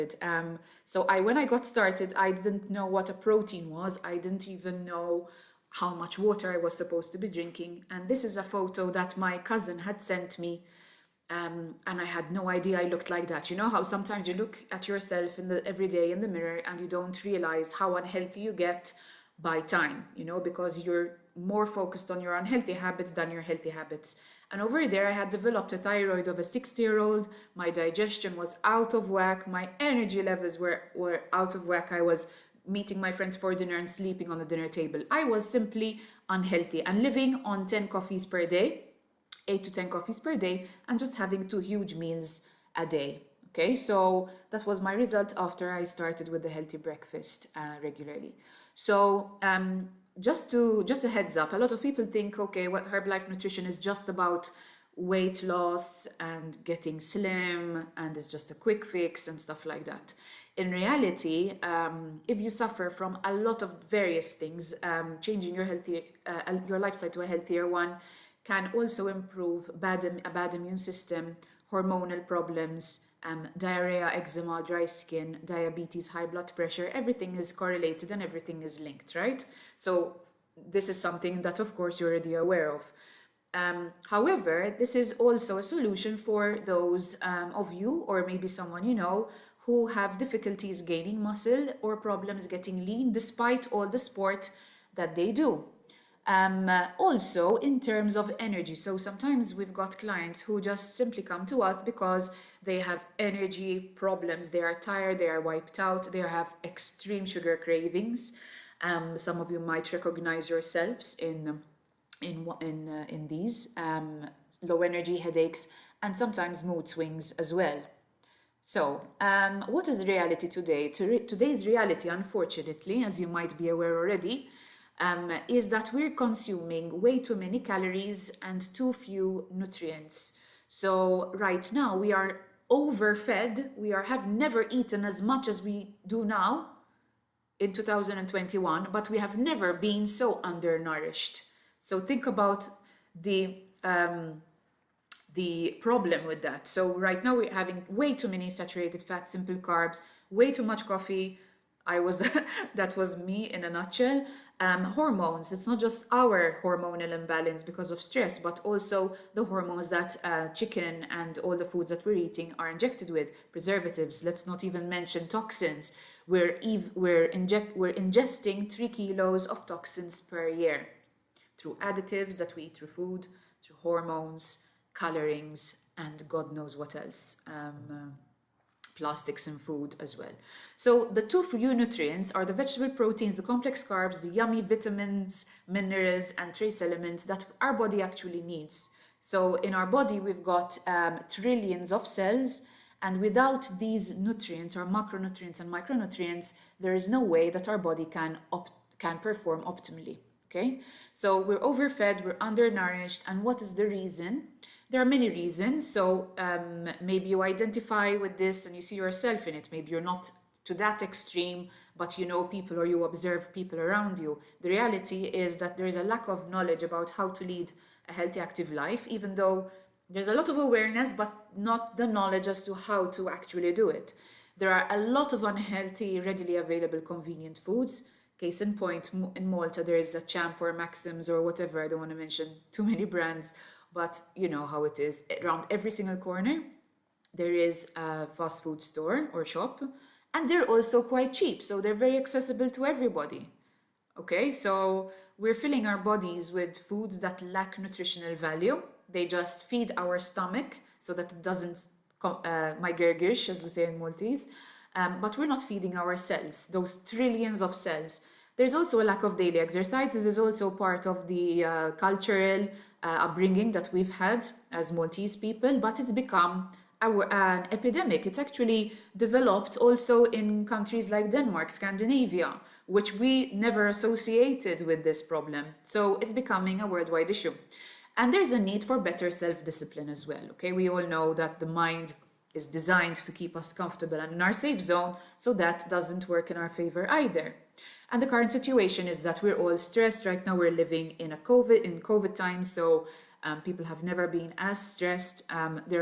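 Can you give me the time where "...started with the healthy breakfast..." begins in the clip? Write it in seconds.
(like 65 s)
45 s.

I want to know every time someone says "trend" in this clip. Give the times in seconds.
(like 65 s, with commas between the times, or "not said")
not said.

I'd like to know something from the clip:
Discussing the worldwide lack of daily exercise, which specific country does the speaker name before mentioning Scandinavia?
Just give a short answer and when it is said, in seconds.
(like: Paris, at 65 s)
Denmark, at 271 s.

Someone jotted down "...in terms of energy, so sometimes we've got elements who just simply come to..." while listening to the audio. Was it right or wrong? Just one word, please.
wrong.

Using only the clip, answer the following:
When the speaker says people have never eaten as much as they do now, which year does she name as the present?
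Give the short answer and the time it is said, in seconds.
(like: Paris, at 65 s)
2021, at 137 s.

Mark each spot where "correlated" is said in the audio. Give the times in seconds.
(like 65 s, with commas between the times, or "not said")
77 s.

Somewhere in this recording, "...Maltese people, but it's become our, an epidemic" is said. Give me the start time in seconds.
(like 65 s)
264 s.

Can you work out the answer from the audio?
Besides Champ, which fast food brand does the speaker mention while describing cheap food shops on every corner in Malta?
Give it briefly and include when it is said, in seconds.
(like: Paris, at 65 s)
Maxims, at 230 s.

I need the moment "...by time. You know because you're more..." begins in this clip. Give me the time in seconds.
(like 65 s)
19 s.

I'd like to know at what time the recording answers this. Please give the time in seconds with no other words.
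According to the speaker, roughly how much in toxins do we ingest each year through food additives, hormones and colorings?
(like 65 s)
168 s.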